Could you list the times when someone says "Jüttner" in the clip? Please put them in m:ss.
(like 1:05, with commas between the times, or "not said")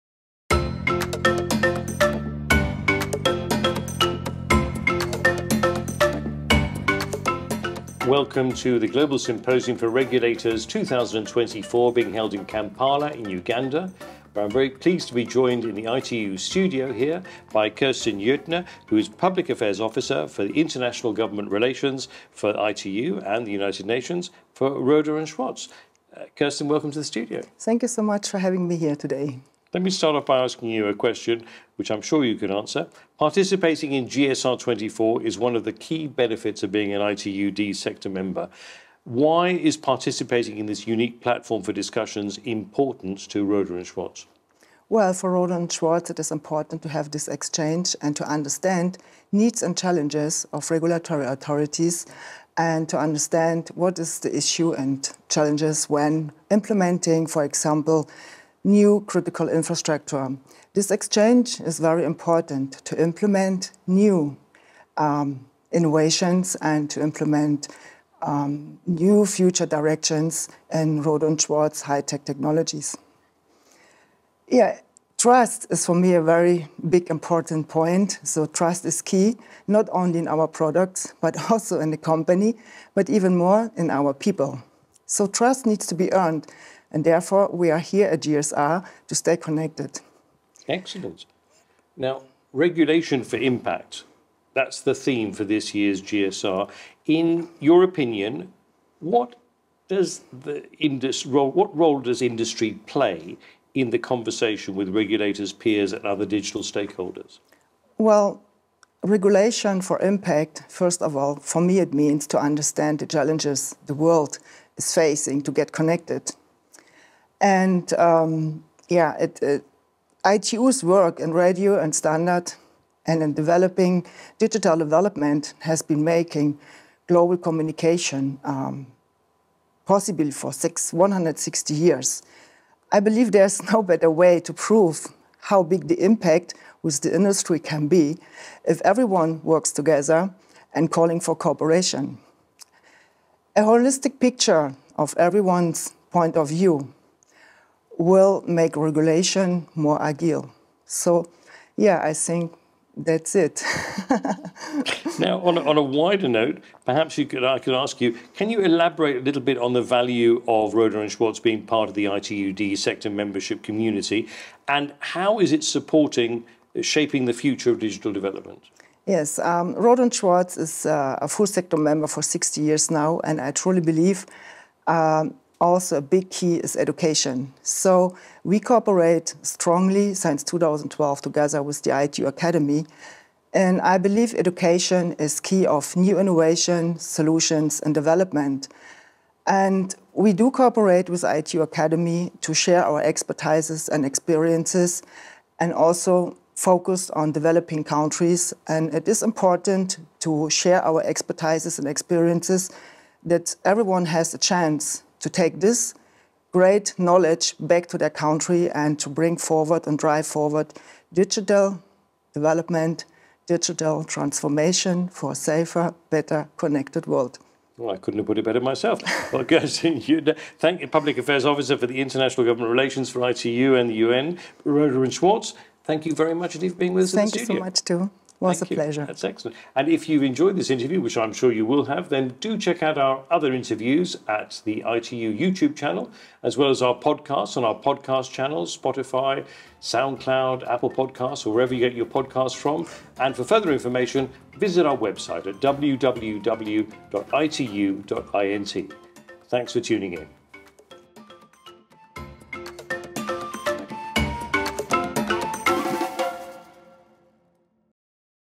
0:18.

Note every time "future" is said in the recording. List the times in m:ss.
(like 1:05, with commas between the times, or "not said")
1:09, 2:47.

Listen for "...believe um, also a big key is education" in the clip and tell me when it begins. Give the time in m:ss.
2:53.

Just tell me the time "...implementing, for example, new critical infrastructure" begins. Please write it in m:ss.
0:56.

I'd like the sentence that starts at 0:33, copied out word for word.
Participating in GSR 24 is one of the key benefits of being an ITU-D sector member.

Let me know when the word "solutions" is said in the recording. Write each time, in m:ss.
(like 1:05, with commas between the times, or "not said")
3:06.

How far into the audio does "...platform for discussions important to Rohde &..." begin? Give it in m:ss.
0:41.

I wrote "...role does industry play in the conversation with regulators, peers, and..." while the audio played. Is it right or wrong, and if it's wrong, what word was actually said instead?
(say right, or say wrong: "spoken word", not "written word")
right.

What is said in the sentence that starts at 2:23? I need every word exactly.
A holistic picture of everyone's point of view will make regulation more agile.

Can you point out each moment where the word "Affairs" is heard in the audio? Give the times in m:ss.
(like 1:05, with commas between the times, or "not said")
0:19, 3:41.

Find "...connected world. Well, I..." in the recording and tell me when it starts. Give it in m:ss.
3:36.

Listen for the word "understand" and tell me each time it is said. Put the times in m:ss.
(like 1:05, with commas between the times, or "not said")
0:48, 0:52, 1:52.